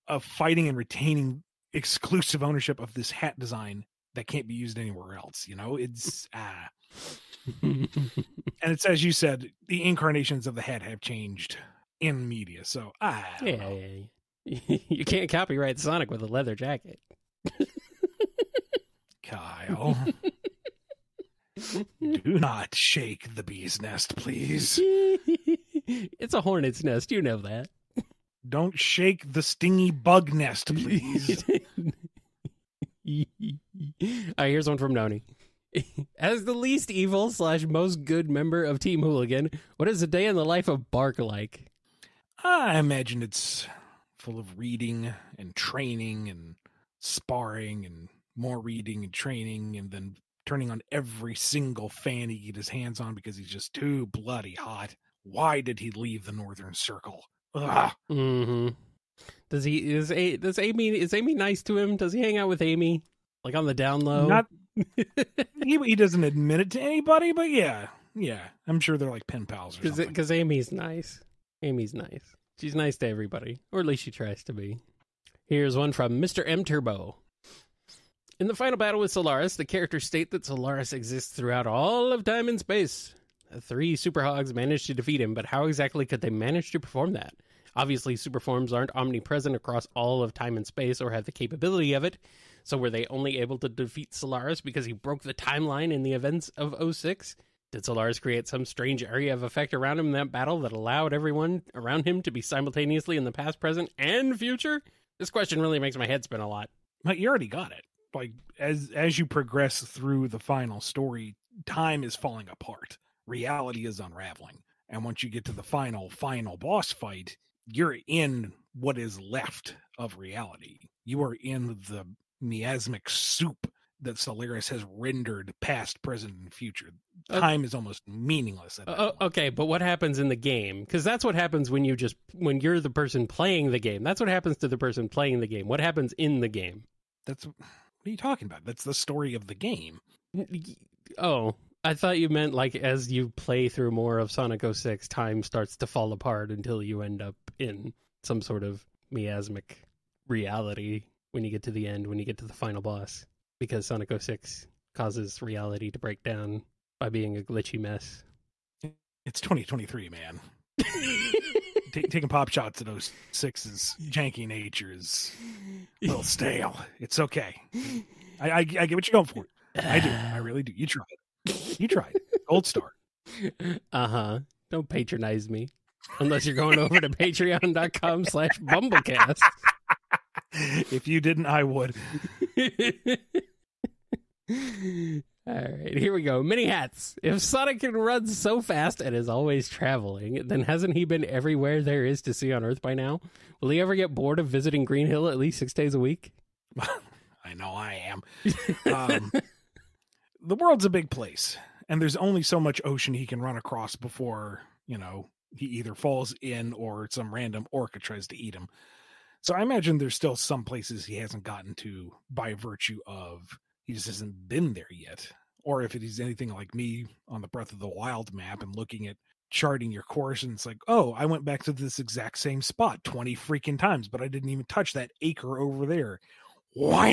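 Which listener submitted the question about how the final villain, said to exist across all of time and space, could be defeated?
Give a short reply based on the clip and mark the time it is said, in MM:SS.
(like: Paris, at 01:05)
Mr. M Turbo, at 01:16.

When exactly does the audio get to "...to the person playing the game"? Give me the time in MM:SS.
02:14.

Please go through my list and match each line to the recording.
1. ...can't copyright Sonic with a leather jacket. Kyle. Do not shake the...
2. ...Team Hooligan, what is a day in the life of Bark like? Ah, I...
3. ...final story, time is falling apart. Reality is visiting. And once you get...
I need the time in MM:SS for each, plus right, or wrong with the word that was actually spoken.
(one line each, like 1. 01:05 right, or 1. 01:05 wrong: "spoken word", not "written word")
1. 00:15 right
2. 00:38 right
3. 01:50 wrong: "unraveling", not "visiting".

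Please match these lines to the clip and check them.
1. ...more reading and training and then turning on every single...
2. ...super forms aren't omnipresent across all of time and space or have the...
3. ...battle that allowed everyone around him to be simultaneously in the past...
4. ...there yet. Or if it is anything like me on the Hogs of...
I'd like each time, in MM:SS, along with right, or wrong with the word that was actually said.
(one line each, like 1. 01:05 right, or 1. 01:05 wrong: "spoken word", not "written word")
1. 00:48 right
2. 01:28 right
3. 01:40 right
4. 03:34 wrong: "Breath", not "Hogs".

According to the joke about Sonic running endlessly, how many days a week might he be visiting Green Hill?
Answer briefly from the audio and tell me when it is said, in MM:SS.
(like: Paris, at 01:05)
6, at 03:15.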